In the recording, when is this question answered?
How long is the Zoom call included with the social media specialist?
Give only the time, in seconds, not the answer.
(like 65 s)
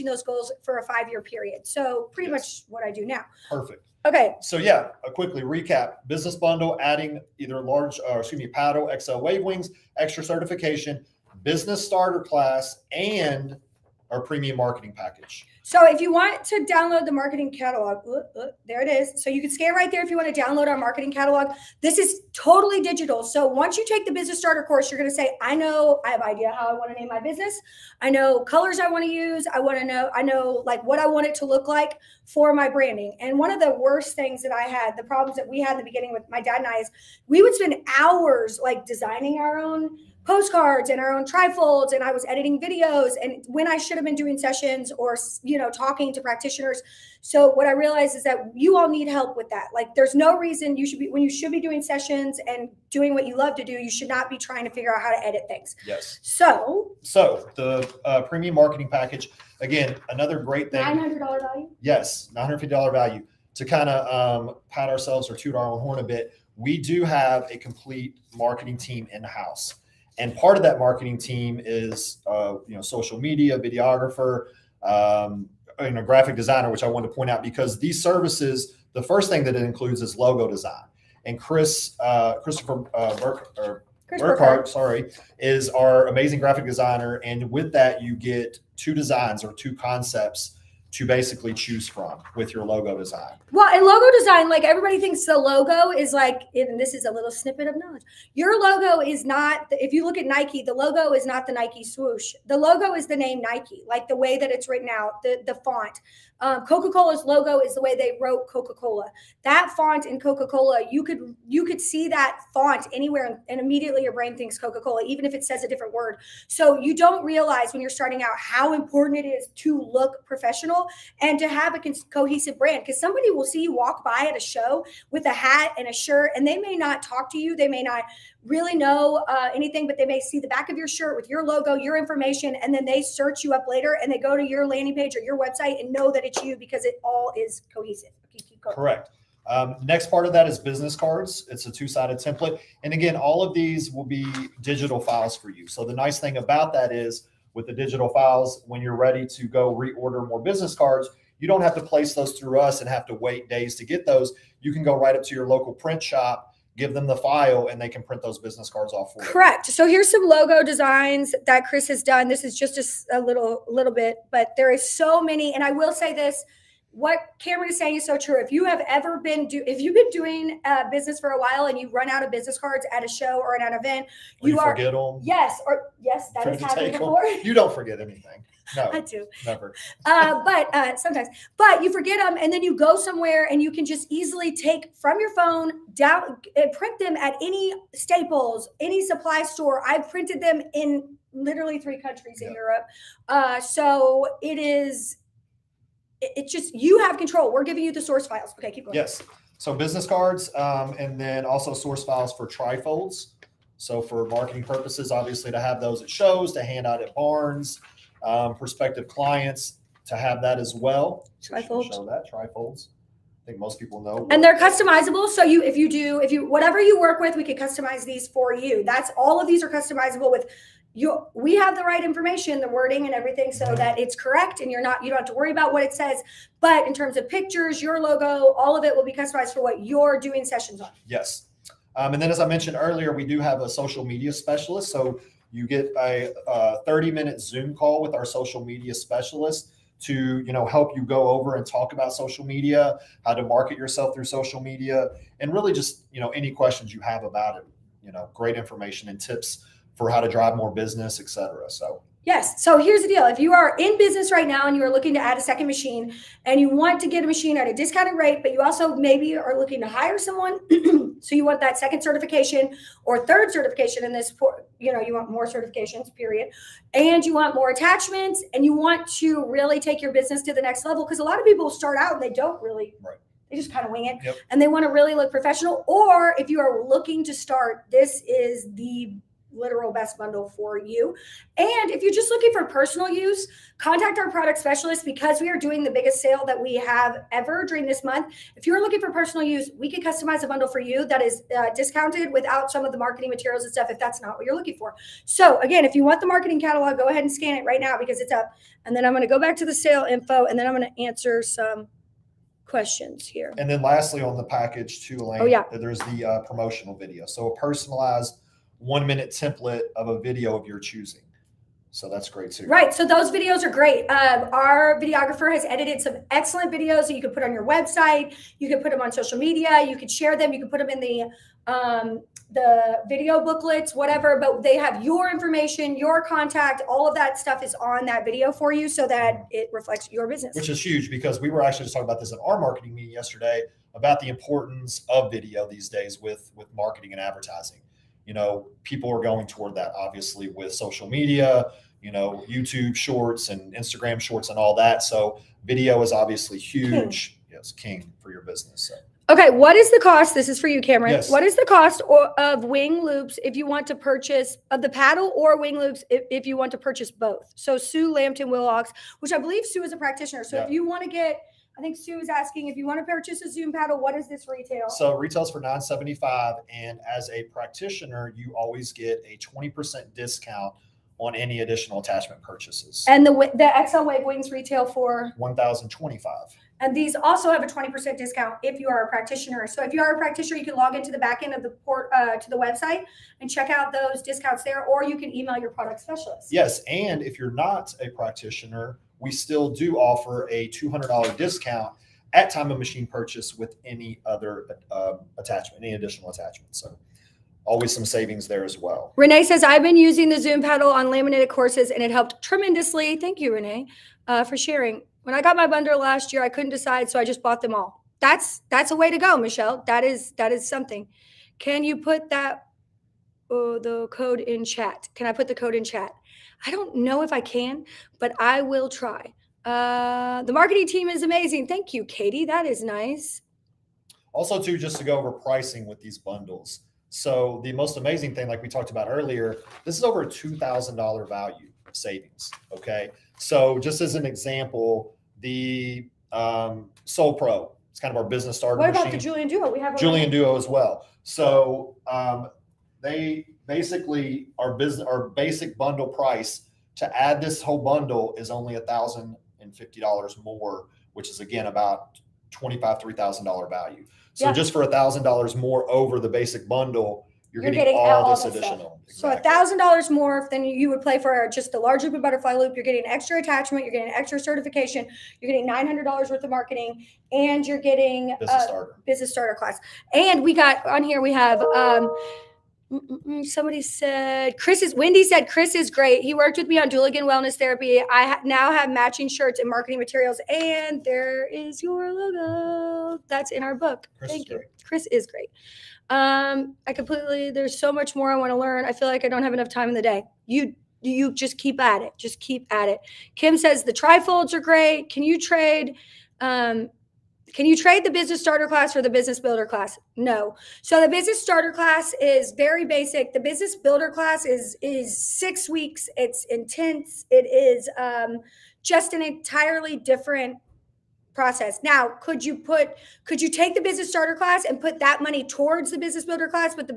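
236 s.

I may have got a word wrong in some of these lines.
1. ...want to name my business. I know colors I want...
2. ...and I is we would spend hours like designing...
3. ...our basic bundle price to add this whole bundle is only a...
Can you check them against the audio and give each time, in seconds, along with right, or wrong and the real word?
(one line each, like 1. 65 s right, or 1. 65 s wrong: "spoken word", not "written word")
1. 26 s right
2. 36 s right
3. 445 s right.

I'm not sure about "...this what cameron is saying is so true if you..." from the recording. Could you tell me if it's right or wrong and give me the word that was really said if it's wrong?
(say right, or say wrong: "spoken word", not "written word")
right.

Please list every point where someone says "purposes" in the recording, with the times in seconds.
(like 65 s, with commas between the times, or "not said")
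204 s.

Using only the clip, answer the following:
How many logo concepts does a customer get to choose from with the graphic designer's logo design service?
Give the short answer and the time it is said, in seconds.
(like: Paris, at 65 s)
2, at 88 s.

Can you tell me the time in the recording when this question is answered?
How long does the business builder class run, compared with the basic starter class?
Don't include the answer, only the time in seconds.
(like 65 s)
505 s.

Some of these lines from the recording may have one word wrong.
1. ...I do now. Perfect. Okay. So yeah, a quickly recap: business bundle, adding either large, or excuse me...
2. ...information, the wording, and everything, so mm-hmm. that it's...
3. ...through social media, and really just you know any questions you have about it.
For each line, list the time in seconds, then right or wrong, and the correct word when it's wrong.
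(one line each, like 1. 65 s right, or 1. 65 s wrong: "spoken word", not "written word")
1. 2 s right
2. 222 s right
3. 244 s right.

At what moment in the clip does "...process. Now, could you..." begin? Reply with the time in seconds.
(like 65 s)
511 s.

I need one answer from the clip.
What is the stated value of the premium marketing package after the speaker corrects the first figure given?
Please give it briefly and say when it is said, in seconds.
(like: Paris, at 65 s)
$950, at 62 s.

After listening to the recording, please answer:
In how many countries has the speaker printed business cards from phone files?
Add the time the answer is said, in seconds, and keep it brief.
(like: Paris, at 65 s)
3, at 191 s.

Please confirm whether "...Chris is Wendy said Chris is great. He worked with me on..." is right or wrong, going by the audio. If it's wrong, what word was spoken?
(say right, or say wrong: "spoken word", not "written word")
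right.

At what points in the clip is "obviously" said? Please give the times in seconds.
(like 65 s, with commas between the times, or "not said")
205 s, 339 s, 346 s.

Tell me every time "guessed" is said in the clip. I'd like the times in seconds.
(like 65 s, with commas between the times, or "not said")
not said.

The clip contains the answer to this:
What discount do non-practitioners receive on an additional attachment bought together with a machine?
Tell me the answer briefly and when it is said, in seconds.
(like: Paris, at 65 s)
$200, at 390 s.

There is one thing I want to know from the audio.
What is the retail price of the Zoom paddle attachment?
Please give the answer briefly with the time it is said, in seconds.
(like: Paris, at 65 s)
$975, at 365 s.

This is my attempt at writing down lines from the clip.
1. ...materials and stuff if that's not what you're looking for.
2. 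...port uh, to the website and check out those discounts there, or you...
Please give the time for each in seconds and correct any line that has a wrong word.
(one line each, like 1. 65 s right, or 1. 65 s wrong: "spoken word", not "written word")
1. 293 s right
2. 381 s right.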